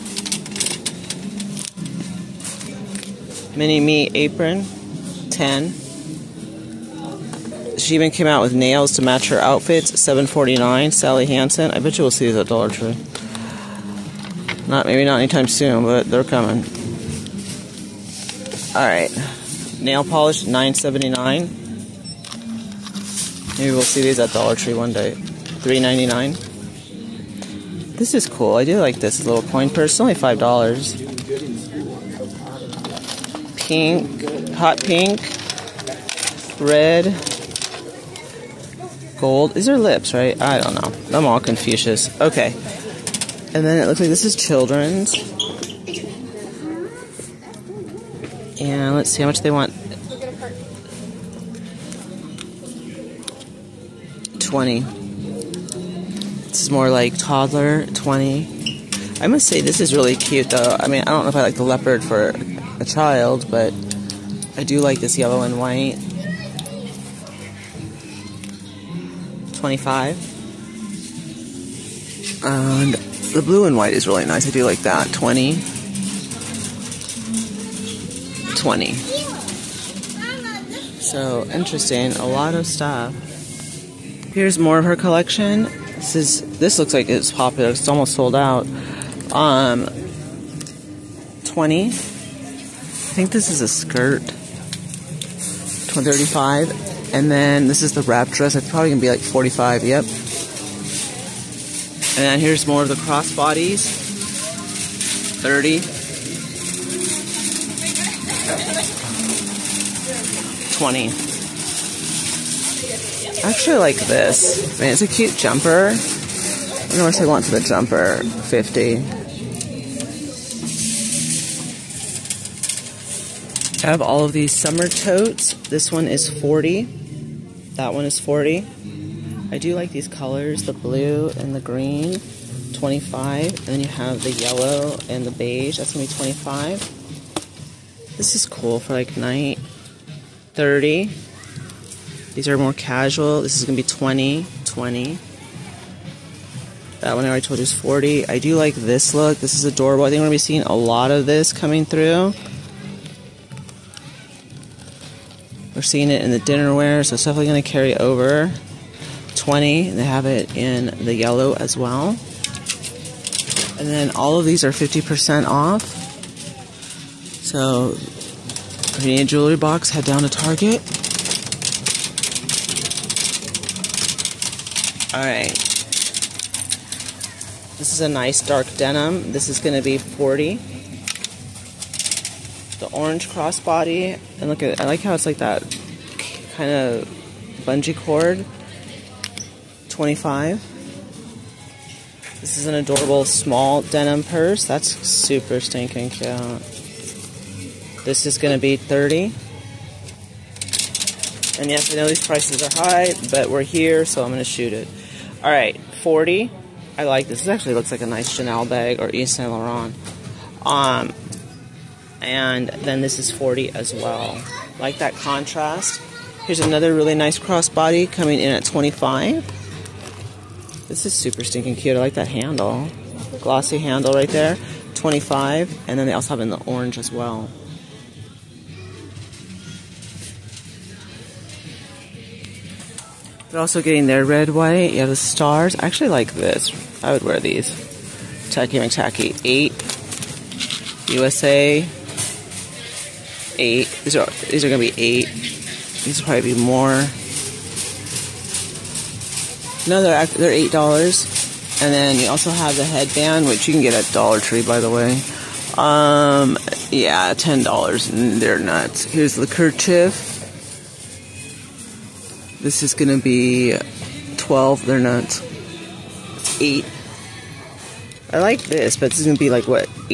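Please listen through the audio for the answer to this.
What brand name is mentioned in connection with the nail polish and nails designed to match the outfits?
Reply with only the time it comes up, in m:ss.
0:10.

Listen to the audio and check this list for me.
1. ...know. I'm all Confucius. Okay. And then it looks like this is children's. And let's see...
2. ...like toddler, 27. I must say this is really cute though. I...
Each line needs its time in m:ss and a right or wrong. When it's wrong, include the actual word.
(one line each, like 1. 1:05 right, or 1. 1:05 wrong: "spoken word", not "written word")
1. 0:40 right
2. 0:56 wrong: "20", not "27".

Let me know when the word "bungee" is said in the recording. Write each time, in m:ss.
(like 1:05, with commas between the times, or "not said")
3:07.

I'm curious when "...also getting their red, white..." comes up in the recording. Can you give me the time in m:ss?
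3:53.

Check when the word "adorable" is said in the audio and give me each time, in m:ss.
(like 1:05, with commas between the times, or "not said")
2:29, 3:12.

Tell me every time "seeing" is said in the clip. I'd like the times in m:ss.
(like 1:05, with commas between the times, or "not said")
2:30, 2:35.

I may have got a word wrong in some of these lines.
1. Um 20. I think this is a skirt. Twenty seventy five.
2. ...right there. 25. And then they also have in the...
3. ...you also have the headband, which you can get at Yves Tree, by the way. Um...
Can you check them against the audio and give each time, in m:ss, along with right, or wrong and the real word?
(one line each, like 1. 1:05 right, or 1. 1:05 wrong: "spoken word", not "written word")
1. 1:29 wrong: "thirty", not "seventy"
2. 3:44 right
3. 4:12 wrong: "Dollar", not "Yves".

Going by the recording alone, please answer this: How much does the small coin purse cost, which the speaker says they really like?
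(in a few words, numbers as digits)
$5.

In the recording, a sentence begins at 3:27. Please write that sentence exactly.
This actually looks like a nice Chanel bag or Yves Saint Laurent.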